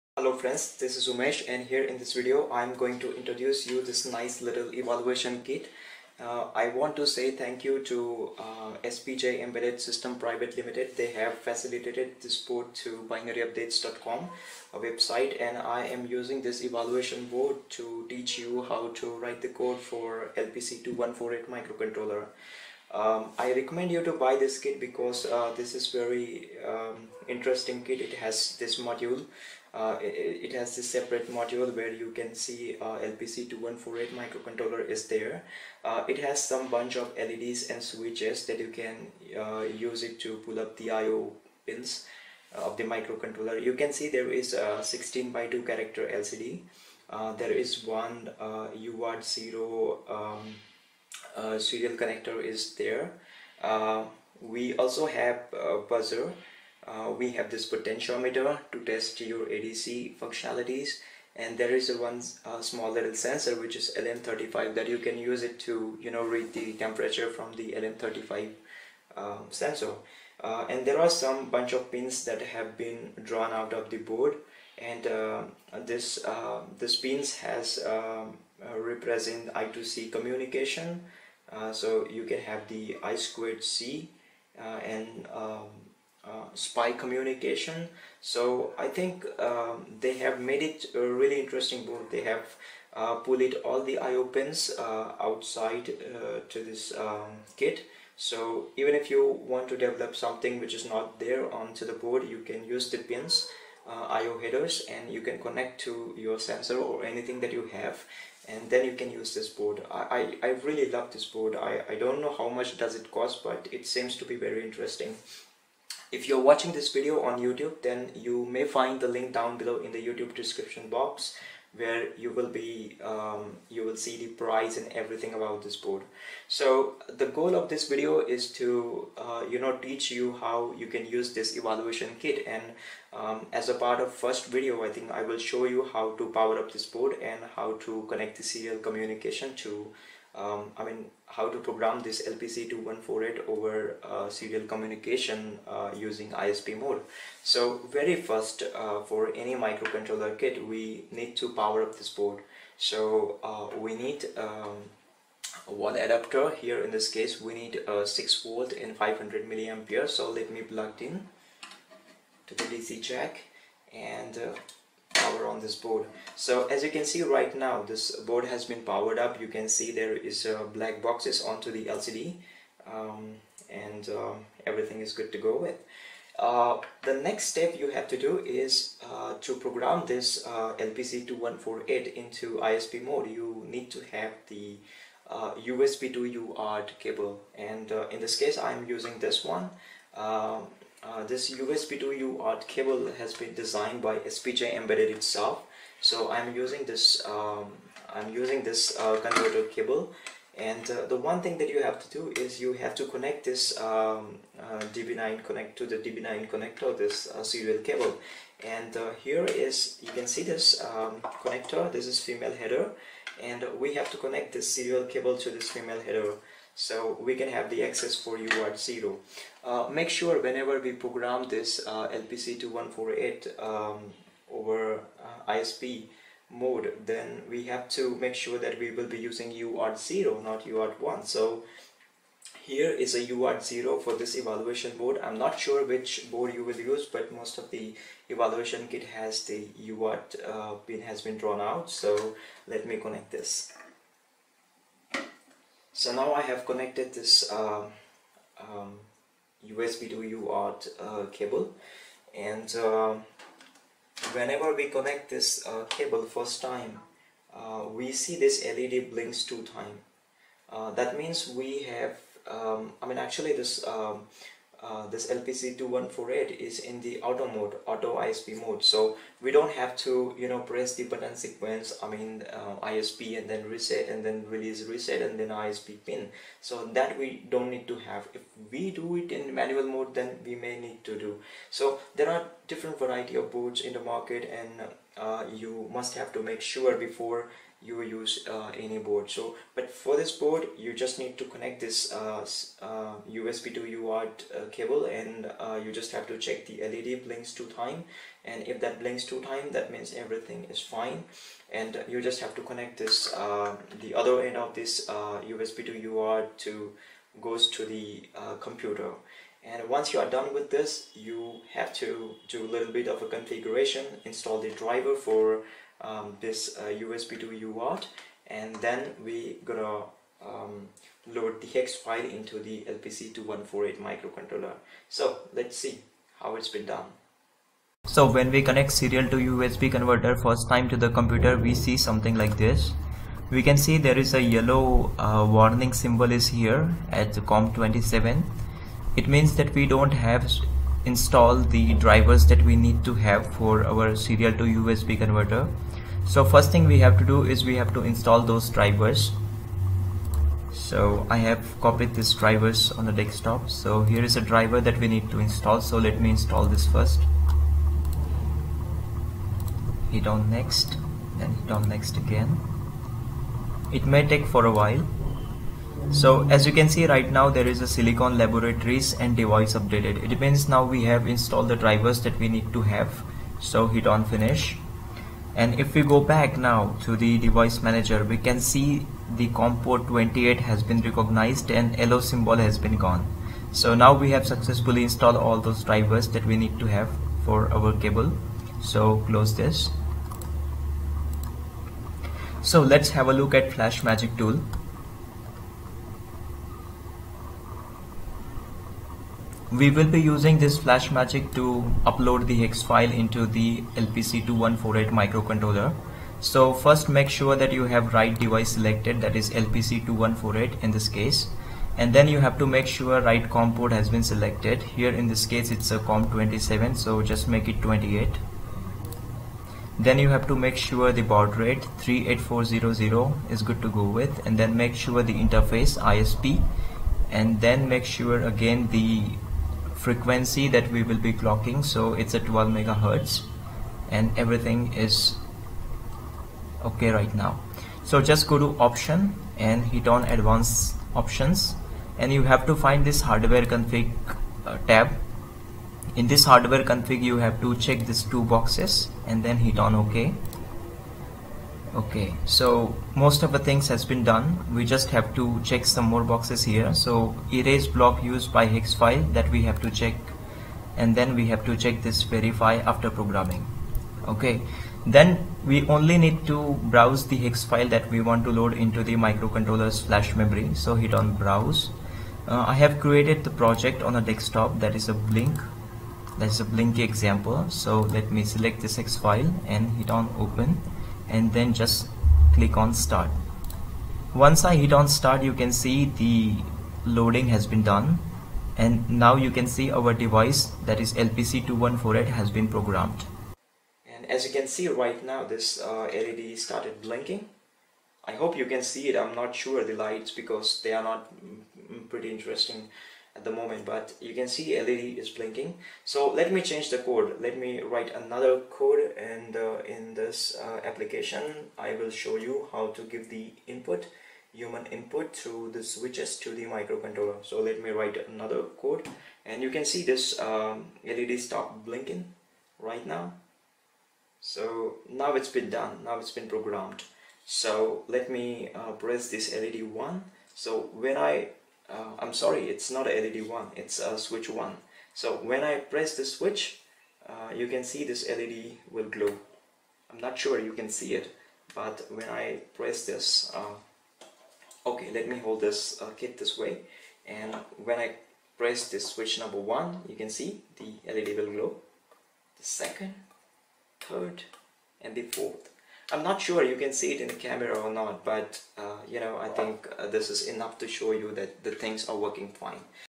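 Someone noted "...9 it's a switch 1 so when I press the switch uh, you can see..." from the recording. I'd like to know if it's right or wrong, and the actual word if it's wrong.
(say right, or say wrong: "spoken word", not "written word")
wrong: "1", not "9".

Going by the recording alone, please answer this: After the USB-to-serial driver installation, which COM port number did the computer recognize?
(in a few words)
COM port 28.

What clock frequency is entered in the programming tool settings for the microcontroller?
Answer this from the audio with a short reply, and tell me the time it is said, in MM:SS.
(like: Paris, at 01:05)
12 megahertz, at 07:12.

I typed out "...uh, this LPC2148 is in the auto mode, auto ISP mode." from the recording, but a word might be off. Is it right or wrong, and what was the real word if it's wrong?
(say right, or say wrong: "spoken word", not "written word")
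right.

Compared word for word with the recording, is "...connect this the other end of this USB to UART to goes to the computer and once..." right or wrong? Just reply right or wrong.
right.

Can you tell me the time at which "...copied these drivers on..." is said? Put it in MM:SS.
05:51.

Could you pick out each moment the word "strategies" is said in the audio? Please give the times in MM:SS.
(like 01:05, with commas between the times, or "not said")
not said.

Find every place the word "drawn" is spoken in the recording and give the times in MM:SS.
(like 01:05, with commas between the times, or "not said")
01:13, 04:01.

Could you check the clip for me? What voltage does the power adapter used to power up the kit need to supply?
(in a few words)
6 volt.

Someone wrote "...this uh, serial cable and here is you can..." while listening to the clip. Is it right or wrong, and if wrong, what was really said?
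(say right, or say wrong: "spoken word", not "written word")
right.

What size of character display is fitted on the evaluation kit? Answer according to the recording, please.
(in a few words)
16 by 2.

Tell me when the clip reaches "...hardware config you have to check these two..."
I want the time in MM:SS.
07:26.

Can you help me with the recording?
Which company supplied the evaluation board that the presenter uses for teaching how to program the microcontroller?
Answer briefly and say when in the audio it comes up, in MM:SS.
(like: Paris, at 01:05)
SPJ Embedded System Private Limited, at 00:08.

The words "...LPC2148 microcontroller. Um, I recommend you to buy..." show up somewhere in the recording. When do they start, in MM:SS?
00:20.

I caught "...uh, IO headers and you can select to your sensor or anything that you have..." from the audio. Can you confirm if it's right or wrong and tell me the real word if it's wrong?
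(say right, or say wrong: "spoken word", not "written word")
wrong: "connect", not "select".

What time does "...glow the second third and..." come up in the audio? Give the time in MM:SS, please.
09:11.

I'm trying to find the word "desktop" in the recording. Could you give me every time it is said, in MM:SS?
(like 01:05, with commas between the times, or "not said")
05:53, 07:54.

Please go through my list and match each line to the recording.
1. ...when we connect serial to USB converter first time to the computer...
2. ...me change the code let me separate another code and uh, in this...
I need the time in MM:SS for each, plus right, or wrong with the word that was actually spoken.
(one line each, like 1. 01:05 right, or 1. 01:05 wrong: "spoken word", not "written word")
1. 05:28 right
2. 08:26 wrong: "write", not "separate".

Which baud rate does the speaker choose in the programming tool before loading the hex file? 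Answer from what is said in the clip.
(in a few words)
38400.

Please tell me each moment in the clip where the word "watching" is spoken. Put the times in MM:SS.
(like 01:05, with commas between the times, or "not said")
01:56.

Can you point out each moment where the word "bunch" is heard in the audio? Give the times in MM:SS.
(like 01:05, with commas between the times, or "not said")
00:36, 01:11.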